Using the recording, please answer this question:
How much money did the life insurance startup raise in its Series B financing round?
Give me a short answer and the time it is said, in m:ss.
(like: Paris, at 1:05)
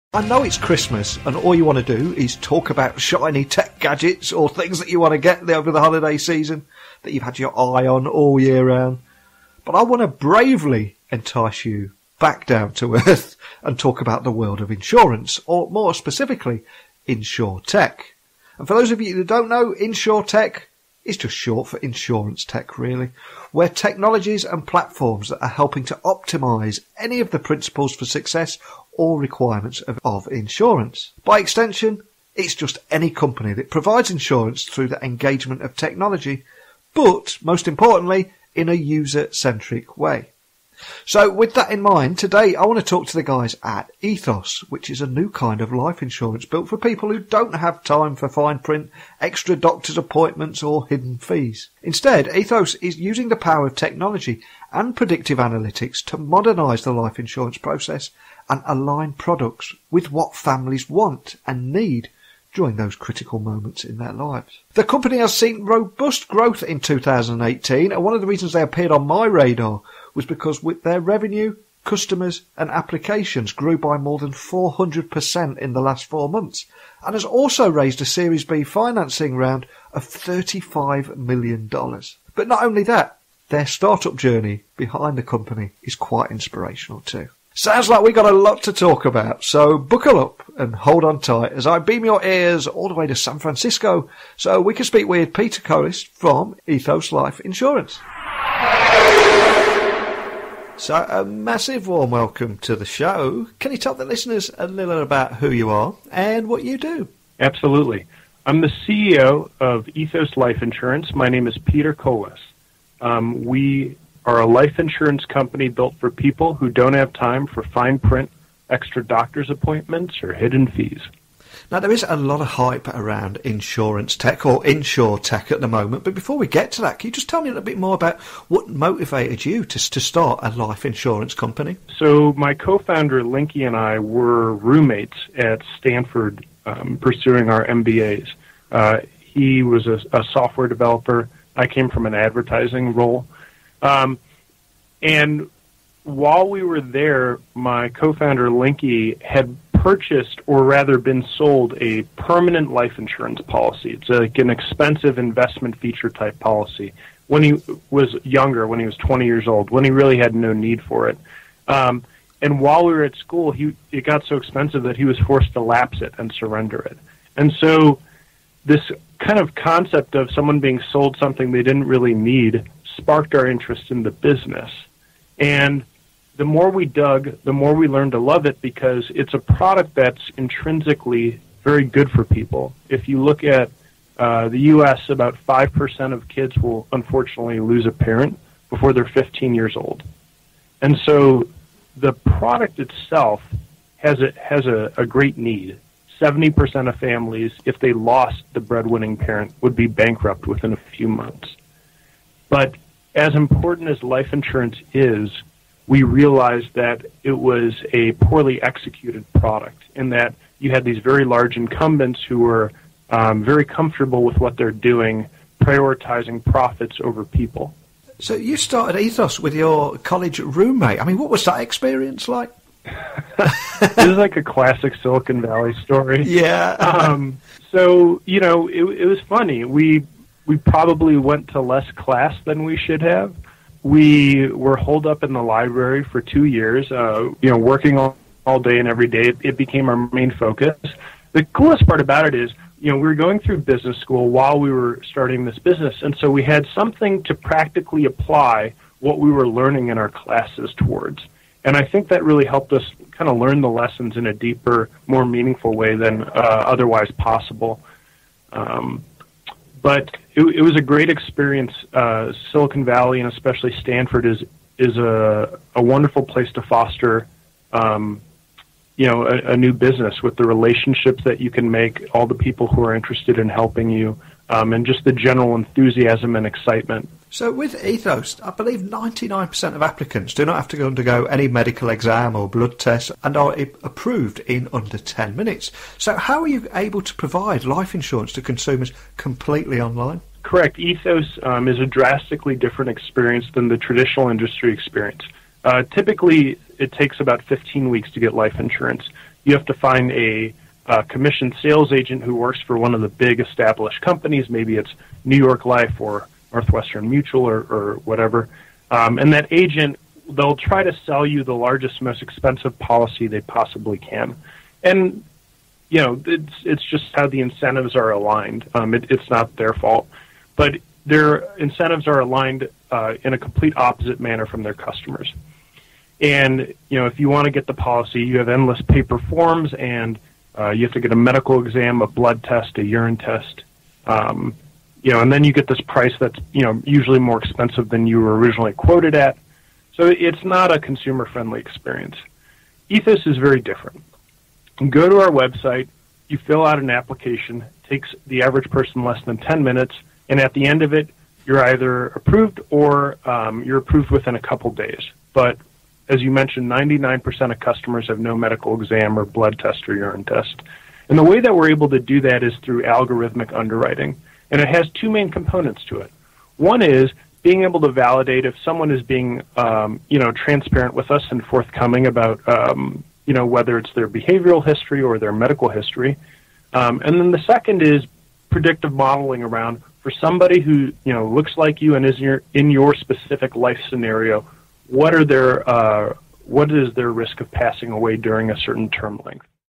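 $35 million, at 1:20.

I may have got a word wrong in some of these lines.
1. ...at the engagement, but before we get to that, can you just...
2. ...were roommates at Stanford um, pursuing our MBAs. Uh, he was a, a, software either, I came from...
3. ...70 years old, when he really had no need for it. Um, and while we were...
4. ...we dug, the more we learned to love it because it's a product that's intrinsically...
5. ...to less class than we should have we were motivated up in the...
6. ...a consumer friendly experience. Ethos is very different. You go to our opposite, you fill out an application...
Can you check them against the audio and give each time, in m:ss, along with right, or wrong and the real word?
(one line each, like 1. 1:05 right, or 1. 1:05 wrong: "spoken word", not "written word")
1. 2:05 wrong: "moment", not "engagement"
2. 2:13 wrong: "developer", not "either"
3. 2:38 wrong: "20", not "70"
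4. 2:56 right
5. 3:51 wrong: "holed", not "motivated"
6. 5:40 wrong: "website", not "opposite".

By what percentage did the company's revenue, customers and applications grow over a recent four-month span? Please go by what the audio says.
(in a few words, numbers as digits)
more than 400%.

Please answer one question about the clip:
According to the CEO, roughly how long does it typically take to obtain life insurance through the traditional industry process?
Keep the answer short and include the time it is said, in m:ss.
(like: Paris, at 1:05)
15 weeks, at 4:57.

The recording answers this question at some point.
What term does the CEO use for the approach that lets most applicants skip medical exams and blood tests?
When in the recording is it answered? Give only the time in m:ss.
6:02.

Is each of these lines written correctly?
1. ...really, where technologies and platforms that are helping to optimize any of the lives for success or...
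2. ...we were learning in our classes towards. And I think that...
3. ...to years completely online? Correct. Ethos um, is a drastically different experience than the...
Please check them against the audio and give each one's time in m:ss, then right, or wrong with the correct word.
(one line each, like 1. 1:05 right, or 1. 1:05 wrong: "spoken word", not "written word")
1. 0:22 wrong: "principles", not "lives"
2. 4:09 right
3. 4:48 wrong: "consumers", not "years".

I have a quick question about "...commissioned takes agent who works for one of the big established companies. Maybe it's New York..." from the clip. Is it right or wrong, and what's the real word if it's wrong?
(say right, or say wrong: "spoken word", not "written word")
wrong: "sales", not "takes".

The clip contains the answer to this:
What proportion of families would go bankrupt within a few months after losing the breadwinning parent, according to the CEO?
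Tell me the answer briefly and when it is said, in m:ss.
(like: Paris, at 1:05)
70%, at 3:16.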